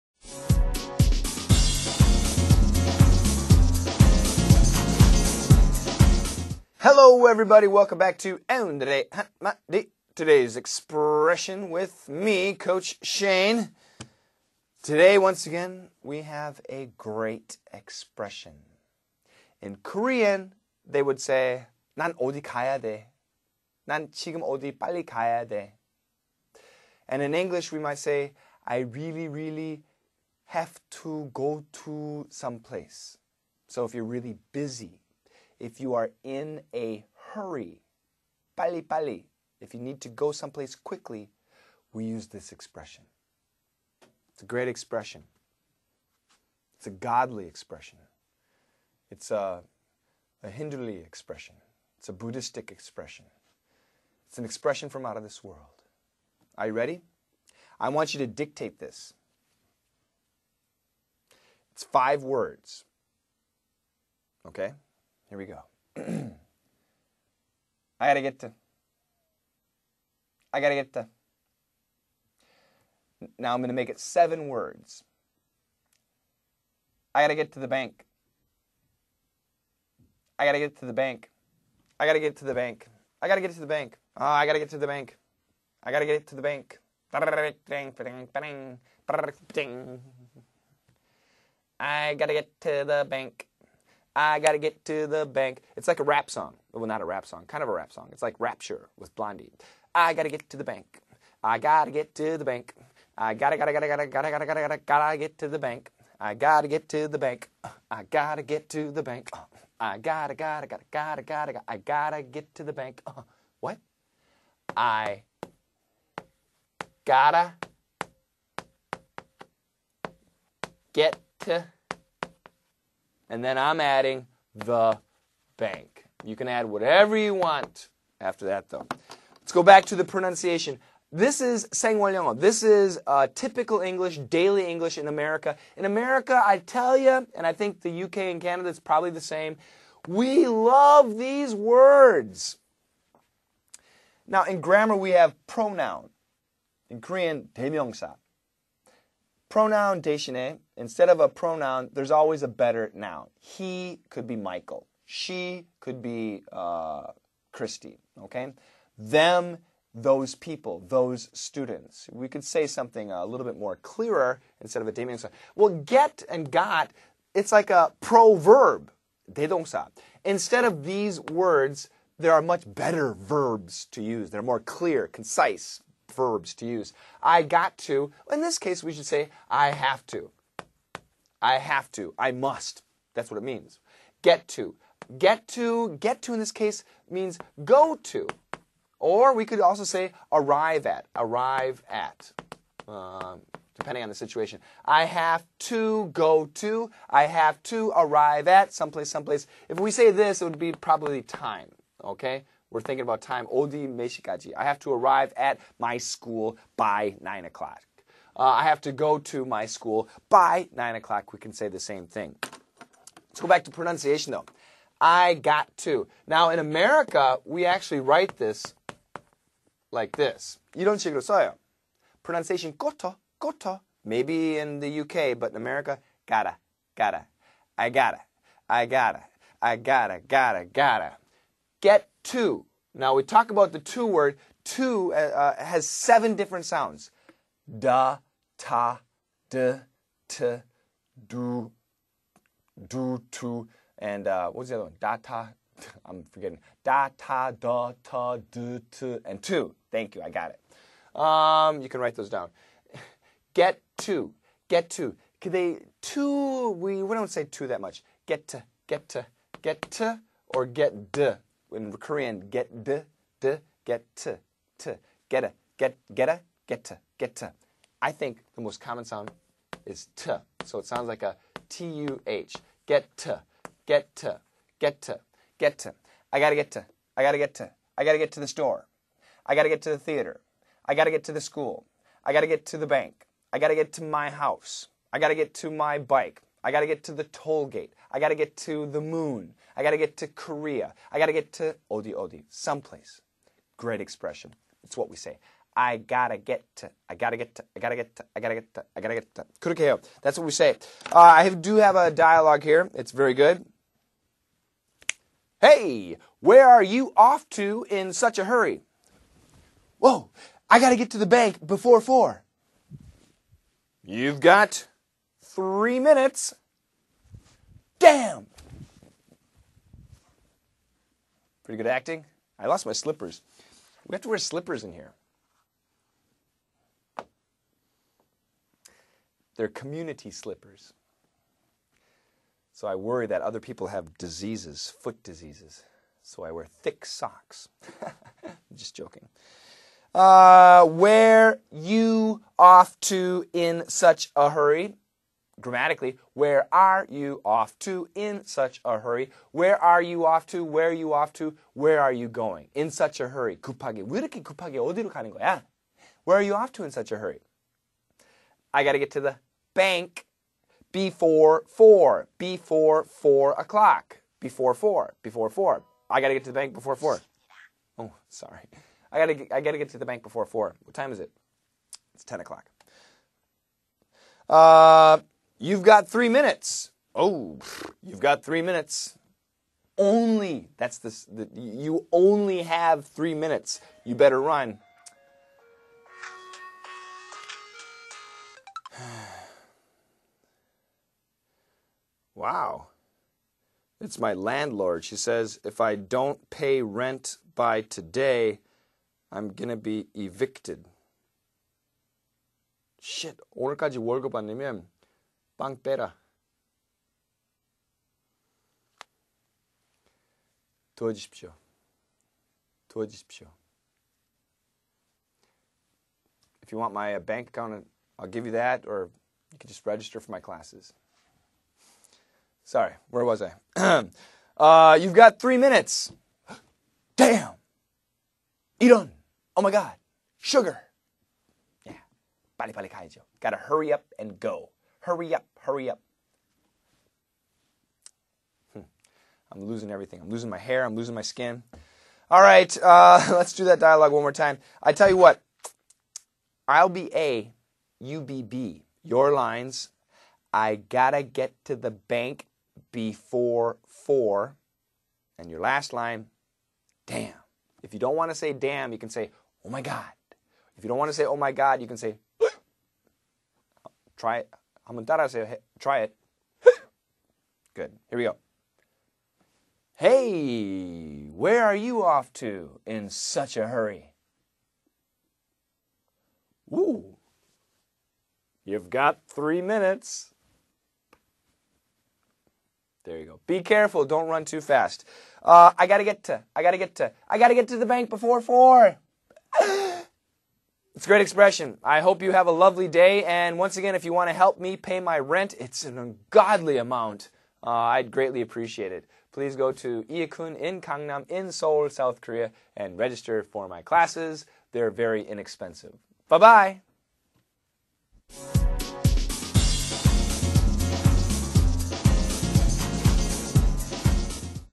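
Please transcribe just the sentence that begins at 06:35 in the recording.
She says, if I don't pay rent by today, I'm going to be evicted.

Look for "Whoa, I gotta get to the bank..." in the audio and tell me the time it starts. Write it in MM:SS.
05:09.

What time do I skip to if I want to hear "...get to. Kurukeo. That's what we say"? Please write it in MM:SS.
04:59.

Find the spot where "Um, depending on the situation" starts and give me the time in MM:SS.
03:12.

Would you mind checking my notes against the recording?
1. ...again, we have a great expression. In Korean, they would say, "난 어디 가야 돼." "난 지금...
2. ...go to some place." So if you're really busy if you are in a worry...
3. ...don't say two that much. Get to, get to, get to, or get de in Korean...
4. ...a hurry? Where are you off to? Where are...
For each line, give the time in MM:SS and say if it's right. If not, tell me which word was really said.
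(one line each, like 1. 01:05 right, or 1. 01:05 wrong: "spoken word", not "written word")
1. 00:15 right
2. 00:31 wrong: "hurry", not "worry"
3. 04:17 right
4. 05:48 right.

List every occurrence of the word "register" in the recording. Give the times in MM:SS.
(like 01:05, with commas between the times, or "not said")
06:59, 08:22.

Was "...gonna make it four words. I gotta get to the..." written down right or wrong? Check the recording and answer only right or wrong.
wrong.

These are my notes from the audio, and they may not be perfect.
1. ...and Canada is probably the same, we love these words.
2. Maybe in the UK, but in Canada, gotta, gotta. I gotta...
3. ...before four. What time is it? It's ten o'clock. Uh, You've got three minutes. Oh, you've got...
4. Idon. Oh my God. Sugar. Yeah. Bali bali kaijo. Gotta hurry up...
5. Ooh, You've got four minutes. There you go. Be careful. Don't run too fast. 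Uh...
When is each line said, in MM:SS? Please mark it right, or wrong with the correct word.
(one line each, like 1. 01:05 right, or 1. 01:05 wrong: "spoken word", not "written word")
1. 02:18 right
2. 03:44 wrong: "America", not "Canada"
3. 06:10 right
4. 07:08 right
5. 07:56 wrong: "three", not "four".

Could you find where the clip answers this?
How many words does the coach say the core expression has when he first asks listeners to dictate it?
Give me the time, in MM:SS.
01:01.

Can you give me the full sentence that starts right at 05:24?
We have to wear slippers in here.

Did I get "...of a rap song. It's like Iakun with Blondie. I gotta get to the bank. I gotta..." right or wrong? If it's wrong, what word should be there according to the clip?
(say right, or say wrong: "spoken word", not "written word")
wrong: "Rapture", not "Iakun".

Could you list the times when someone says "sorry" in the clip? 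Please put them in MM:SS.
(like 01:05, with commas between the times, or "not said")
06:08, 07:02.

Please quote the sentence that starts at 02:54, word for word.
They're more clear, concise, verbs to use.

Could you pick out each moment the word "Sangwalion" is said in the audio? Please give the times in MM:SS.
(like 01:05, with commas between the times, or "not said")
02:11.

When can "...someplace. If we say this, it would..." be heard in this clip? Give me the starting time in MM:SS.
03:19.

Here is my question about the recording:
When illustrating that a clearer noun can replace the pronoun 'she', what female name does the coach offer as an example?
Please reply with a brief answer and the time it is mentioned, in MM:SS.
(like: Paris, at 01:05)
Christy, at 02:37.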